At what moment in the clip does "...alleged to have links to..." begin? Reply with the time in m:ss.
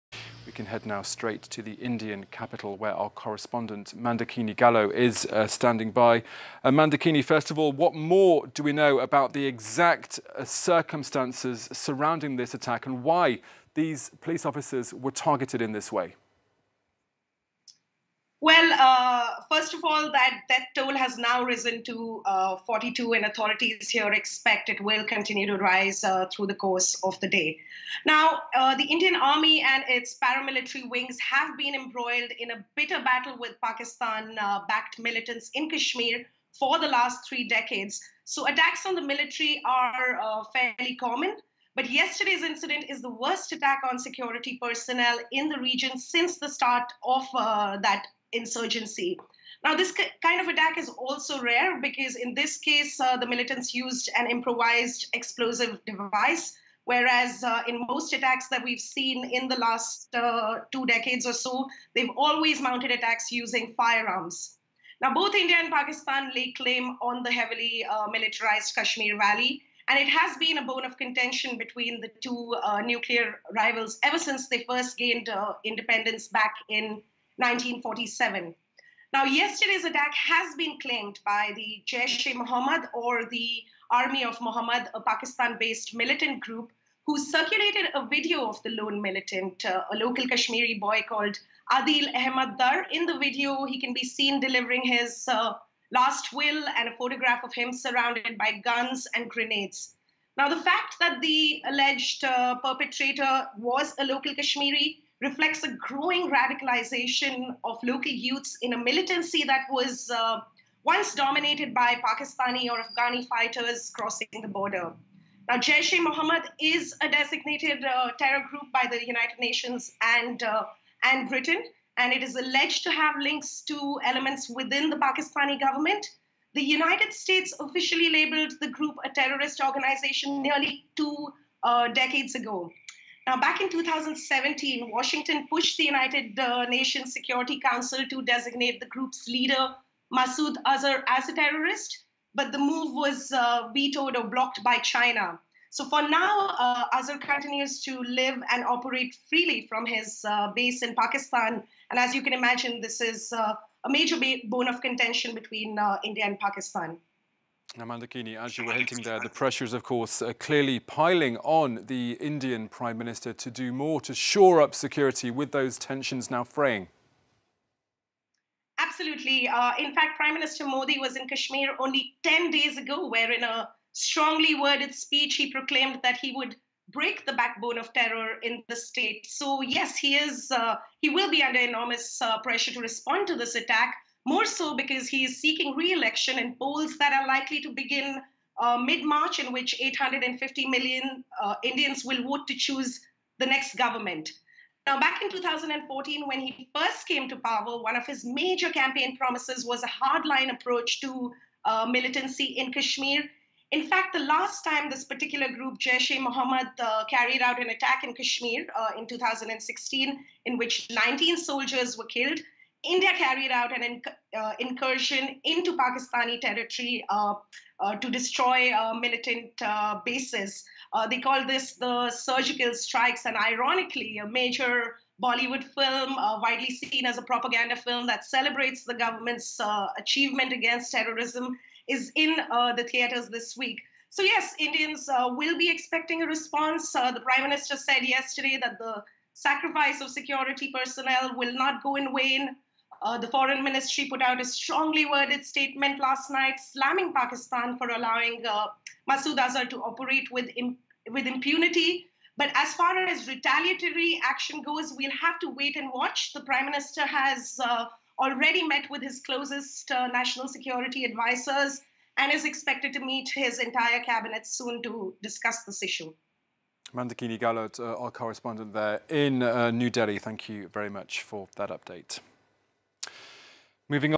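2:02.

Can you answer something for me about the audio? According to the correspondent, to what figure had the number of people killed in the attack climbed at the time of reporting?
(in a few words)
42.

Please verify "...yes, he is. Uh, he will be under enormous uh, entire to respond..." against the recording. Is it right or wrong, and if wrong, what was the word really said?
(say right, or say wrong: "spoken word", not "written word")
wrong: "pressure", not "entire".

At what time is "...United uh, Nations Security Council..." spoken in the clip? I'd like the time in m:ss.
2:15.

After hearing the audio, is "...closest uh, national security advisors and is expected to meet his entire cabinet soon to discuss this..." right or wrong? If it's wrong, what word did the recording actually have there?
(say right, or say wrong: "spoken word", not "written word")
right.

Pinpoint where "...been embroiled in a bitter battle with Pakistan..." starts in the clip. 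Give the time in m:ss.
0:31.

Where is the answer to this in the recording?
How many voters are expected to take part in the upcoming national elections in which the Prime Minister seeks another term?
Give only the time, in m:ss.
3:09.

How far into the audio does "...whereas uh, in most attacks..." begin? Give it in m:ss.
0:56.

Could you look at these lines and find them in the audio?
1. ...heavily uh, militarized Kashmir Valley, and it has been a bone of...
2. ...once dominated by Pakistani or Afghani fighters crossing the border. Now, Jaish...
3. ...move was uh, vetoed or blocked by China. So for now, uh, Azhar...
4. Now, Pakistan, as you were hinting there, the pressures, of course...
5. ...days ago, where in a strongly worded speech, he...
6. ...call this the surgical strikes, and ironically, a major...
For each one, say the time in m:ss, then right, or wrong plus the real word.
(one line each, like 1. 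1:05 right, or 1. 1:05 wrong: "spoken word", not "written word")
1. 1:07 right
2. 1:50 right
3. 2:22 right
4. 2:37 wrong: "Mandakini", not "Pakistan"
5. 2:52 right
6. 3:41 right.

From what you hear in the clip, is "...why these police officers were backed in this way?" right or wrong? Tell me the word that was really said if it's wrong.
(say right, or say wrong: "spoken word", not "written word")
wrong: "targeted", not "backed".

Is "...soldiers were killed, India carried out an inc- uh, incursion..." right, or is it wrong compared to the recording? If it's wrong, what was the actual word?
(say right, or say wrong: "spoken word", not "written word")
right.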